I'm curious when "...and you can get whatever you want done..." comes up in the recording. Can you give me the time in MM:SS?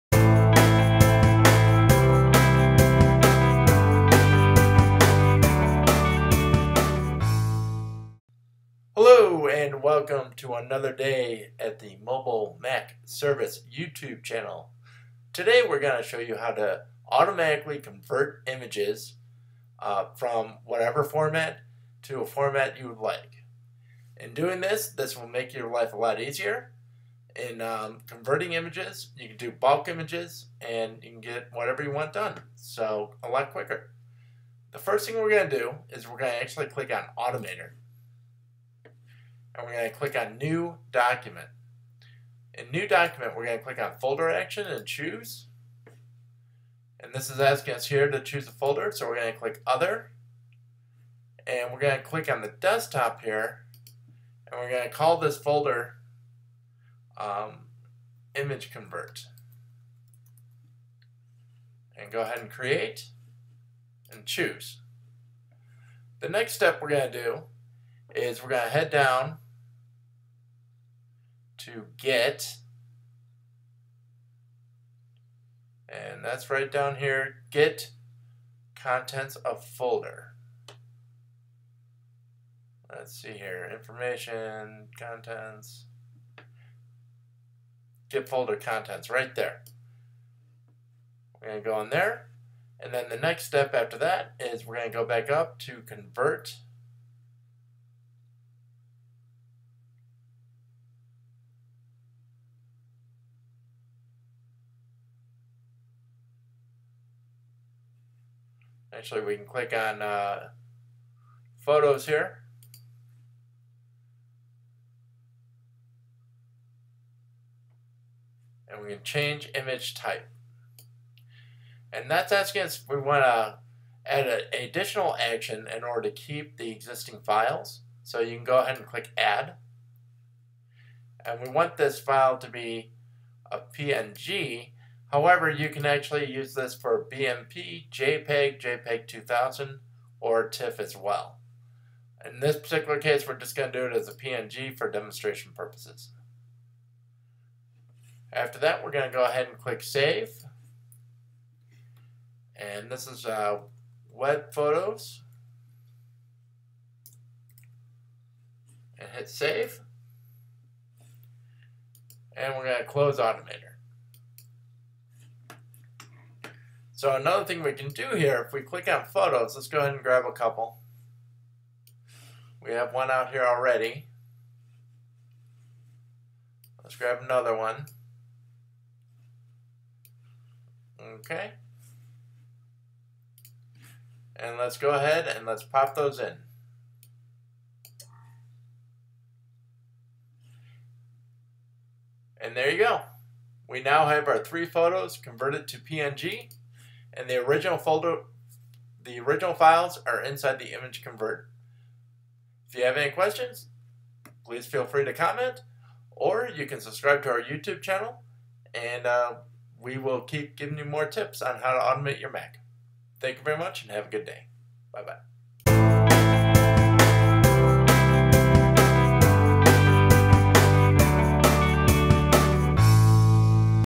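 00:30.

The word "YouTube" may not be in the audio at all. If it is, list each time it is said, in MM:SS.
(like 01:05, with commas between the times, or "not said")
00:13, 03:27.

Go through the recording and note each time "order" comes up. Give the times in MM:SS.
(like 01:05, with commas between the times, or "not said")
02:05.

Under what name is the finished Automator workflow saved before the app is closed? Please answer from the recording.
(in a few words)
Web Photos.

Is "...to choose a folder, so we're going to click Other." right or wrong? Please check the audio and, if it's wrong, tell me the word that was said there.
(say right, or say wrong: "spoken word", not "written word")
right.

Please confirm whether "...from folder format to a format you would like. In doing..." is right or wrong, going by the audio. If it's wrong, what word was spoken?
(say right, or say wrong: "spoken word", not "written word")
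wrong: "whatever", not "folder".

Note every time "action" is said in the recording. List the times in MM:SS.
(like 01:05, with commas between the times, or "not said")
00:44, 02:05.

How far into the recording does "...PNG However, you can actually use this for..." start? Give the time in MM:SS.
02:13.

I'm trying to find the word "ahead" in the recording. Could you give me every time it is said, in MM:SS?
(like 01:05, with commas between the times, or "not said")
01:02, 02:08, 02:29, 02:49, 03:04.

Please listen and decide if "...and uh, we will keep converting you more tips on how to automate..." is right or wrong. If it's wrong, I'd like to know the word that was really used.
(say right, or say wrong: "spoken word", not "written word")
wrong: "giving", not "converting".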